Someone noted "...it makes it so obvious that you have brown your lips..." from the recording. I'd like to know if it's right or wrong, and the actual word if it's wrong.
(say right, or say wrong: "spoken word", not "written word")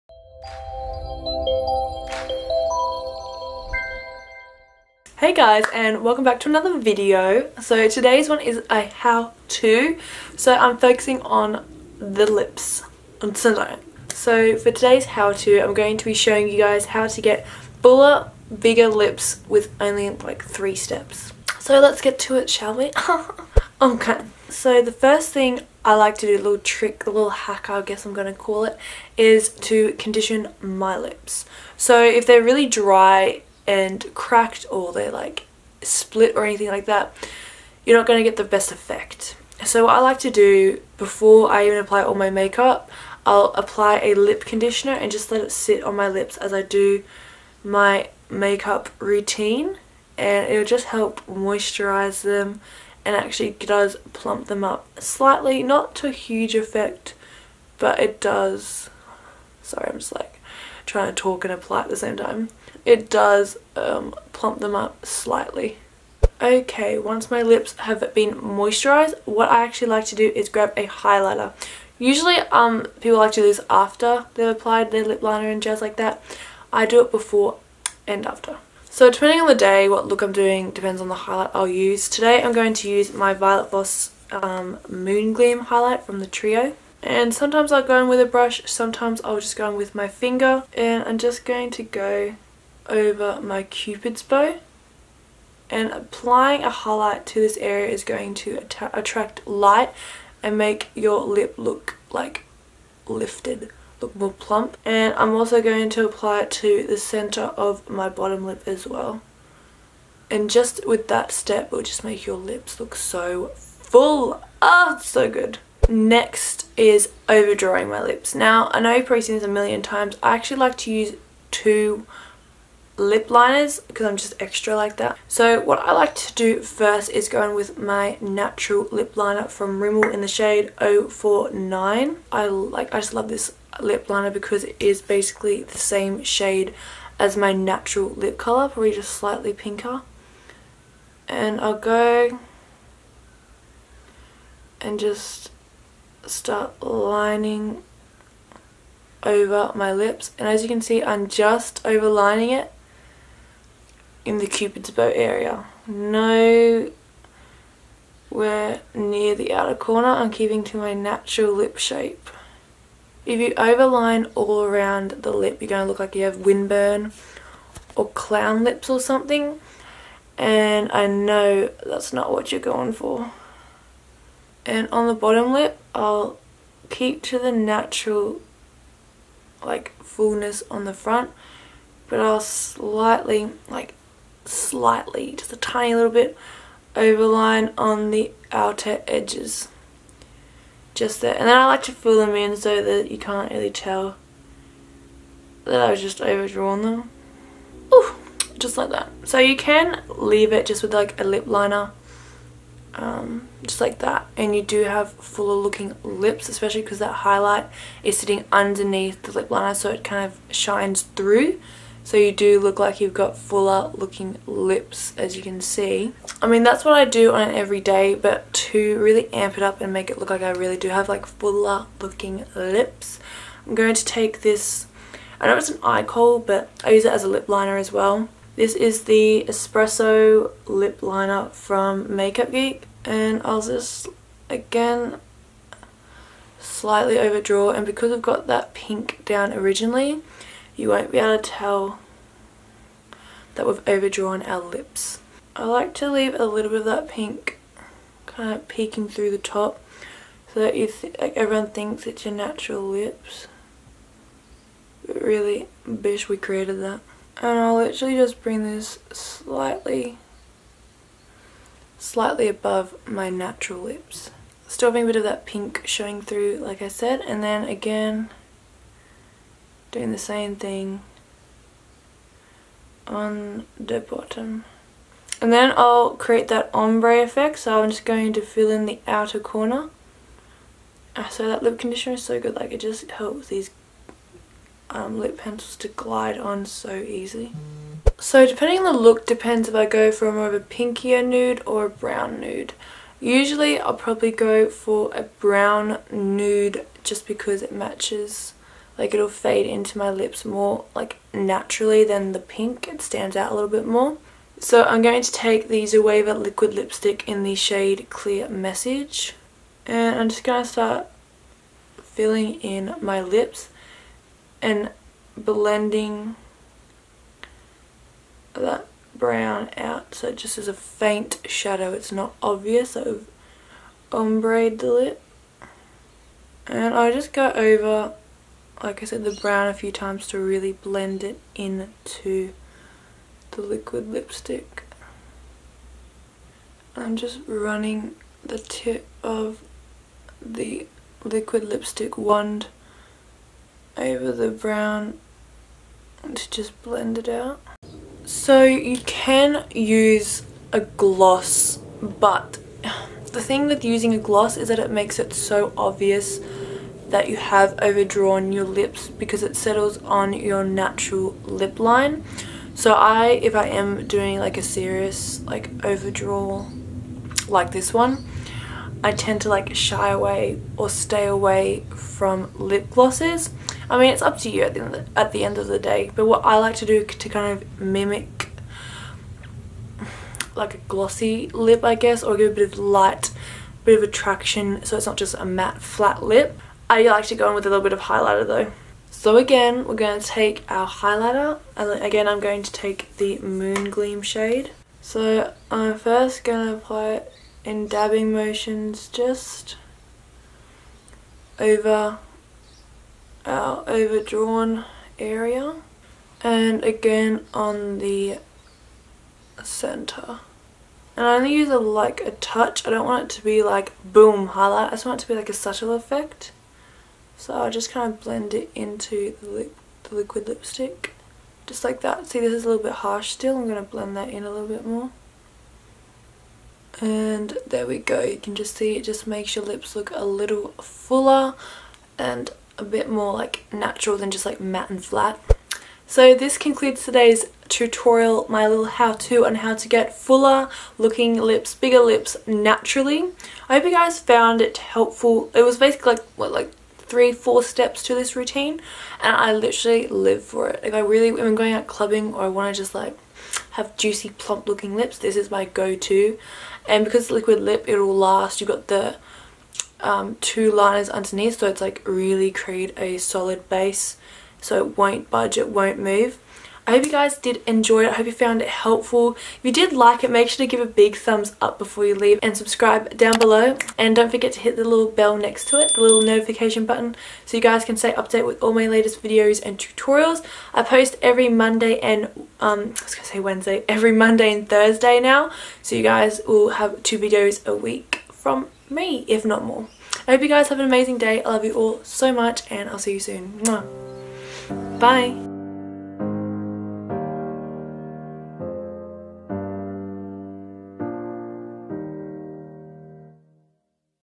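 wrong: "overdrawn", not "brown".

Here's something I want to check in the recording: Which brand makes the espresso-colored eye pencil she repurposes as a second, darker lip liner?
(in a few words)
Makeup Geek.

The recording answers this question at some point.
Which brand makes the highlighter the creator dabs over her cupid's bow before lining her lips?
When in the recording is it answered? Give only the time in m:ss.
1:23.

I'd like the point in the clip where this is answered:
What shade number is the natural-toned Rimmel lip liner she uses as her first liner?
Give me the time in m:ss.
2:10.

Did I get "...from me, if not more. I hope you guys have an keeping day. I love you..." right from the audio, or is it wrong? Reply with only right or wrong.
wrong.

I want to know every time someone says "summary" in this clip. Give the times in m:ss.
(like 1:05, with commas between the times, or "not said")
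not said.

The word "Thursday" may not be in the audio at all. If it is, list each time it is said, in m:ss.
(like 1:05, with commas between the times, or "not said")
8:04.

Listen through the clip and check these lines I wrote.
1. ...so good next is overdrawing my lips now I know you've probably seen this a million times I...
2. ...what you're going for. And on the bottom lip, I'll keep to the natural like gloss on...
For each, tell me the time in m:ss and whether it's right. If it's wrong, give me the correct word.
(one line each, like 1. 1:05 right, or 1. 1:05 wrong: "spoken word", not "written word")
1. 1:55 right
2. 2:52 wrong: "fullness", not "gloss".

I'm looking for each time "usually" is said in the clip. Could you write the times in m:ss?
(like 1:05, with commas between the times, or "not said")
1:11, 4:53.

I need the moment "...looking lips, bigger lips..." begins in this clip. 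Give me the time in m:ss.
7:20.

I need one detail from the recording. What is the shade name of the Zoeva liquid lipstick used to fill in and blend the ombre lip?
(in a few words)
clear message.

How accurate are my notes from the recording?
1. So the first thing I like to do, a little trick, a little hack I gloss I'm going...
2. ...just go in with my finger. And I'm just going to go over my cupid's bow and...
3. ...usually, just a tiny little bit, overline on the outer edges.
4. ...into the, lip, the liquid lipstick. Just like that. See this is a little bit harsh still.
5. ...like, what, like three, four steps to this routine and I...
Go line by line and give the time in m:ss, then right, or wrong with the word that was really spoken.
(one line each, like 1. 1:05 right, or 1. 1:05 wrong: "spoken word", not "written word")
1. 0:24 wrong: "guess", not "gloss"
2. 1:29 right
3. 3:04 wrong: "slightly", not "usually"
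4. 6:58 right
5. 7:26 right.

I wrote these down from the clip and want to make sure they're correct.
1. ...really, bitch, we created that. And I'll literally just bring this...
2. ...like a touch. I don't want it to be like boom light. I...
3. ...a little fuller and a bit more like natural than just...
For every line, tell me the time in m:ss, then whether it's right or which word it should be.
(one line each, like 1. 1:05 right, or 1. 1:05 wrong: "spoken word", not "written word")
1. 4:15 right
2. 6:51 wrong: "highlight", not "light"
3. 7:10 right.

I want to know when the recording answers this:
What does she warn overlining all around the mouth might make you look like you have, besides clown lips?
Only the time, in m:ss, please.
2:46.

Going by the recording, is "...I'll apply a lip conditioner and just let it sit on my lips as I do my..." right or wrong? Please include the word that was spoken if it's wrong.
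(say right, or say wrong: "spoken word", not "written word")
right.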